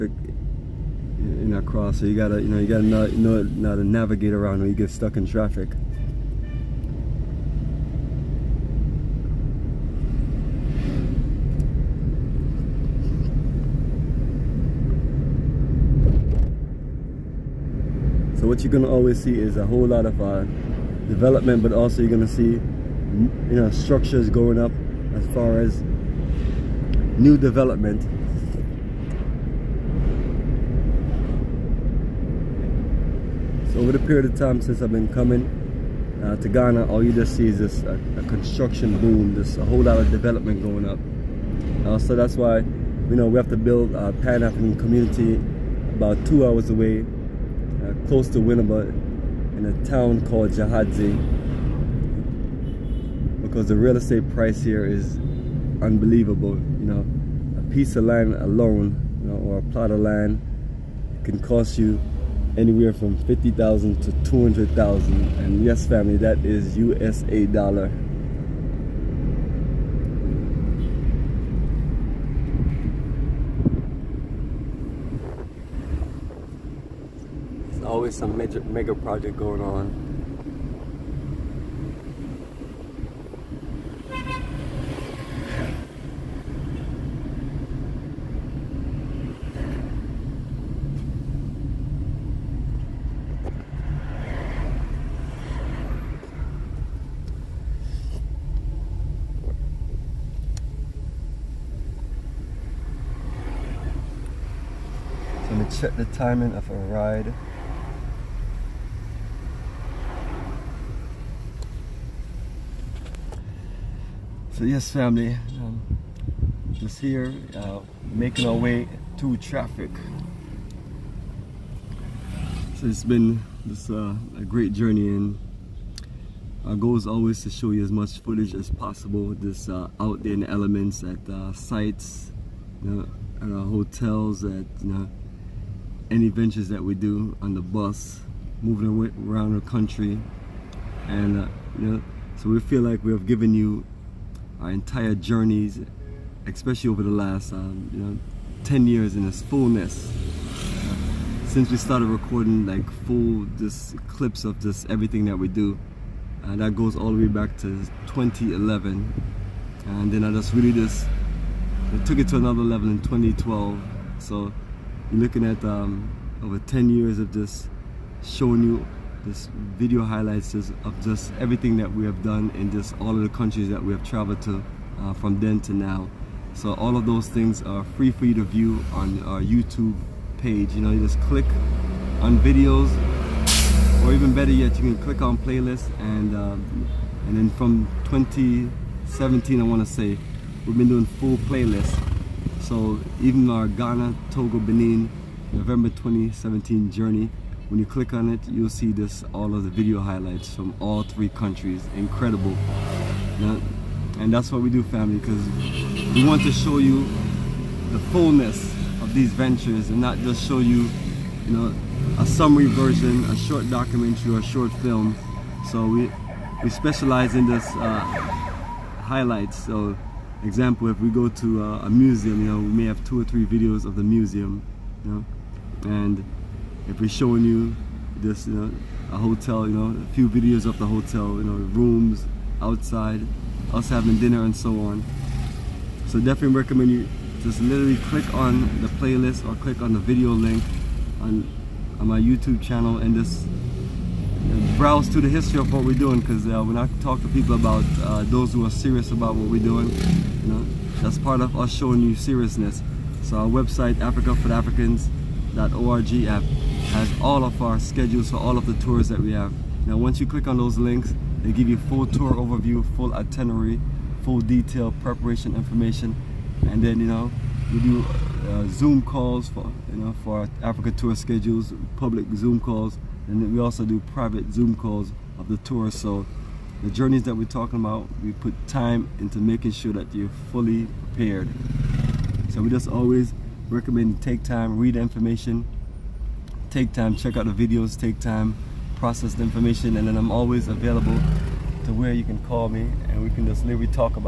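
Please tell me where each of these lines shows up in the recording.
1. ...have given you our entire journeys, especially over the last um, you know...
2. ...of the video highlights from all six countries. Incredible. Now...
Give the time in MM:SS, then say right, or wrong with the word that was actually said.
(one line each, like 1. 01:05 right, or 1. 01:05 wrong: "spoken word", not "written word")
1. 02:23 right
2. 03:19 wrong: "three", not "six".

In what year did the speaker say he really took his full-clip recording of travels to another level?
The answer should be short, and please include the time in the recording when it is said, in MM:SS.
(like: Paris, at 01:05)
2012, at 02:43.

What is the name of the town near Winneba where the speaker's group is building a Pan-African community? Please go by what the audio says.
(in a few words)
Gyaahadze.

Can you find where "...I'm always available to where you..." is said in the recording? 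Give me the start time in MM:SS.
04:50.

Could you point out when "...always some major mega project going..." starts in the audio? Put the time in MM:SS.
01:17.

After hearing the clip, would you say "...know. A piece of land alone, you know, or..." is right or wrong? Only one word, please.
right.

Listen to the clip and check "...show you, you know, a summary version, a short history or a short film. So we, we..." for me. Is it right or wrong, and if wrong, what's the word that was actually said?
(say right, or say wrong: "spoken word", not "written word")
wrong: "documentary", not "history".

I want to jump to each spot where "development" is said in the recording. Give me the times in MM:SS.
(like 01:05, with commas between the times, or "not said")
00:21, 00:27, 00:40.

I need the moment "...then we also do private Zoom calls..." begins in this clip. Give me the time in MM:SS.
04:33.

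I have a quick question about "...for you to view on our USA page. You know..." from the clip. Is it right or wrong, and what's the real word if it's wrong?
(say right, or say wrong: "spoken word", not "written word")
wrong: "YouTube", not "USA".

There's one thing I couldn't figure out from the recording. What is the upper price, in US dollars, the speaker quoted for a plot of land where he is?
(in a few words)
200,000.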